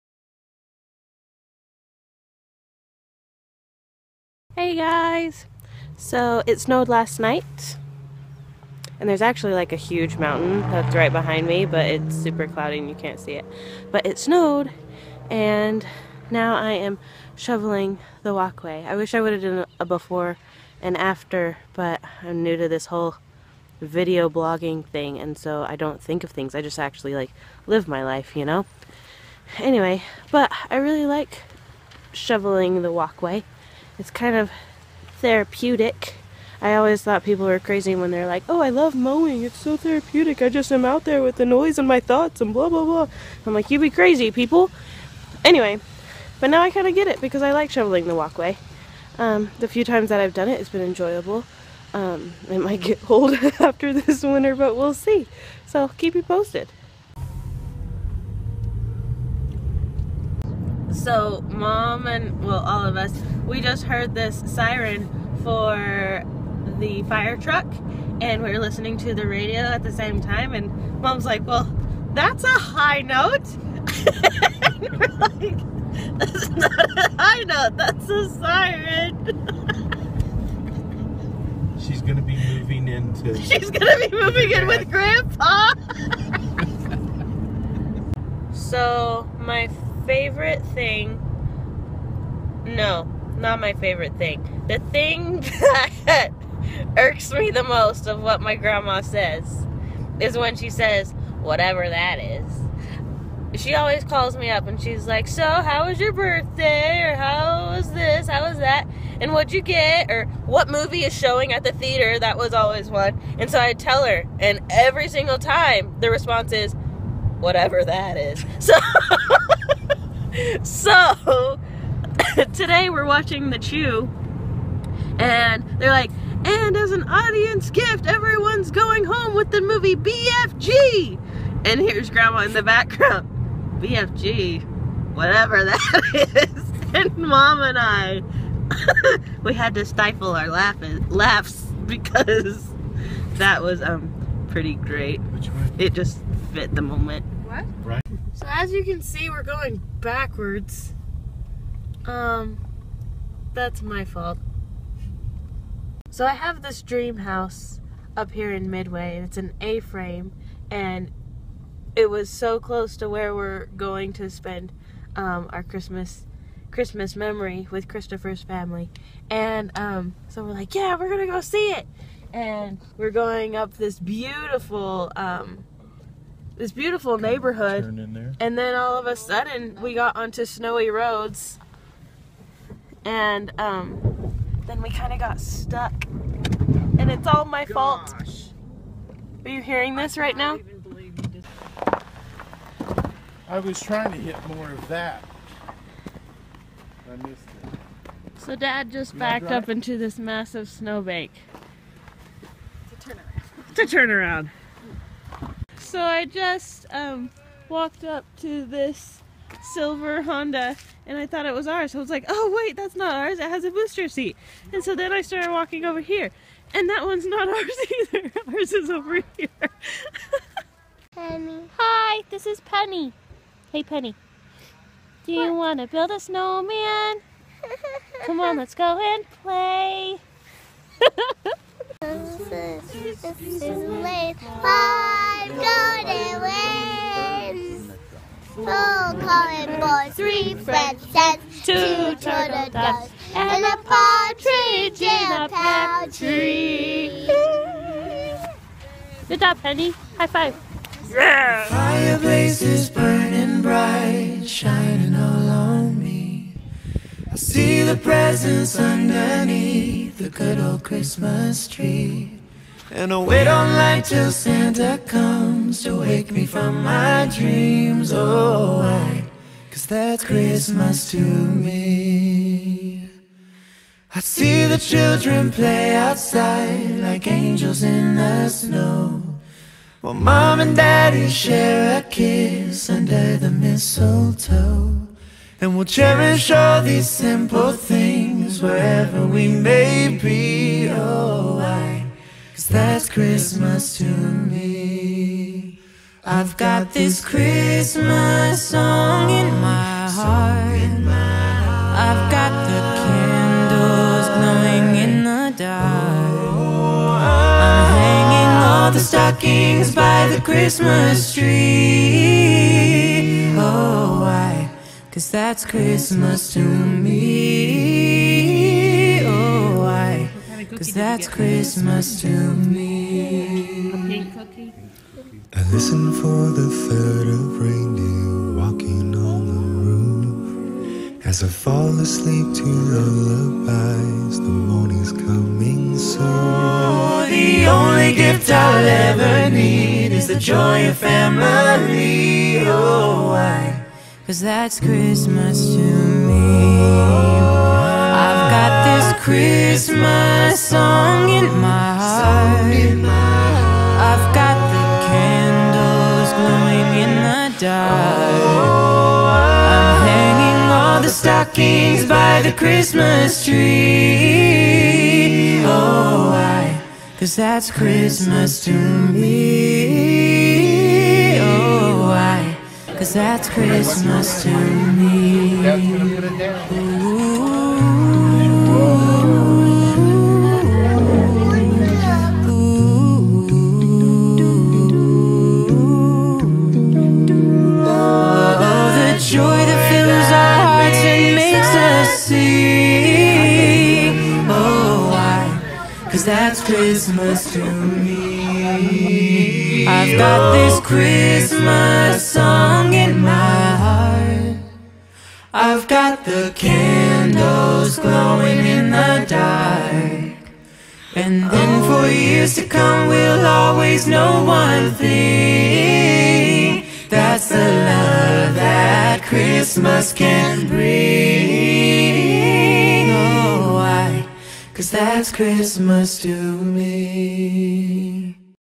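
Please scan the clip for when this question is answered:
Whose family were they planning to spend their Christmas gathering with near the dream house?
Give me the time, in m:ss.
2:47.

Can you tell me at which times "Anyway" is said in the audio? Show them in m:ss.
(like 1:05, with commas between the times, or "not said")
0:29, 0:45.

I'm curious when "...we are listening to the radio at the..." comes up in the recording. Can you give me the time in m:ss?
1:08.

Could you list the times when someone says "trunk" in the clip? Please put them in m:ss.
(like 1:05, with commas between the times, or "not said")
not said.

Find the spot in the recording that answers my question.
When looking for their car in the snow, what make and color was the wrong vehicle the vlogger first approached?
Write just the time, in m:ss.
3:29.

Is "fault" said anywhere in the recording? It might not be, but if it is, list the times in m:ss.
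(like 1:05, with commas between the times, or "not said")
2:34, 3:07.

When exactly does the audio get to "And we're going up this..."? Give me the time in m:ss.
2:52.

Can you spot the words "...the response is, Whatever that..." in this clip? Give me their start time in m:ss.
1:55.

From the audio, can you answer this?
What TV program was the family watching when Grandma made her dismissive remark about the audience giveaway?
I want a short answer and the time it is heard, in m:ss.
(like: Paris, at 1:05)
The Chew, at 2:03.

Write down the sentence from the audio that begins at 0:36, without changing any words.
I always thought people were crazy when they're like, oh, I love mowing.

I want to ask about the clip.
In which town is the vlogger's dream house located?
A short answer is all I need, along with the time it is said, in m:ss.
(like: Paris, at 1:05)
Midway, at 2:38.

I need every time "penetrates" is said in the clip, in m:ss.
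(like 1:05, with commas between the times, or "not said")
not said.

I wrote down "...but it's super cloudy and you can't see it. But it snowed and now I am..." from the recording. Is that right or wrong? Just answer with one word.
right.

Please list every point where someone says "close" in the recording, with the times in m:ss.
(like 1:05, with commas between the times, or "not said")
2:42.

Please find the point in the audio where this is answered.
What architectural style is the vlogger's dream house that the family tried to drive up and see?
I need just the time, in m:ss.
2:39.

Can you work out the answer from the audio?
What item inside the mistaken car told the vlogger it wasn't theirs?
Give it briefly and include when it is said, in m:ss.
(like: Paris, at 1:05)
Booster seat, at 3:33.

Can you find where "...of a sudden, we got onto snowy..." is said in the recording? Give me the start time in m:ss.
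2:58.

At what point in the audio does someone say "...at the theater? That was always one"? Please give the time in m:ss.
1:51.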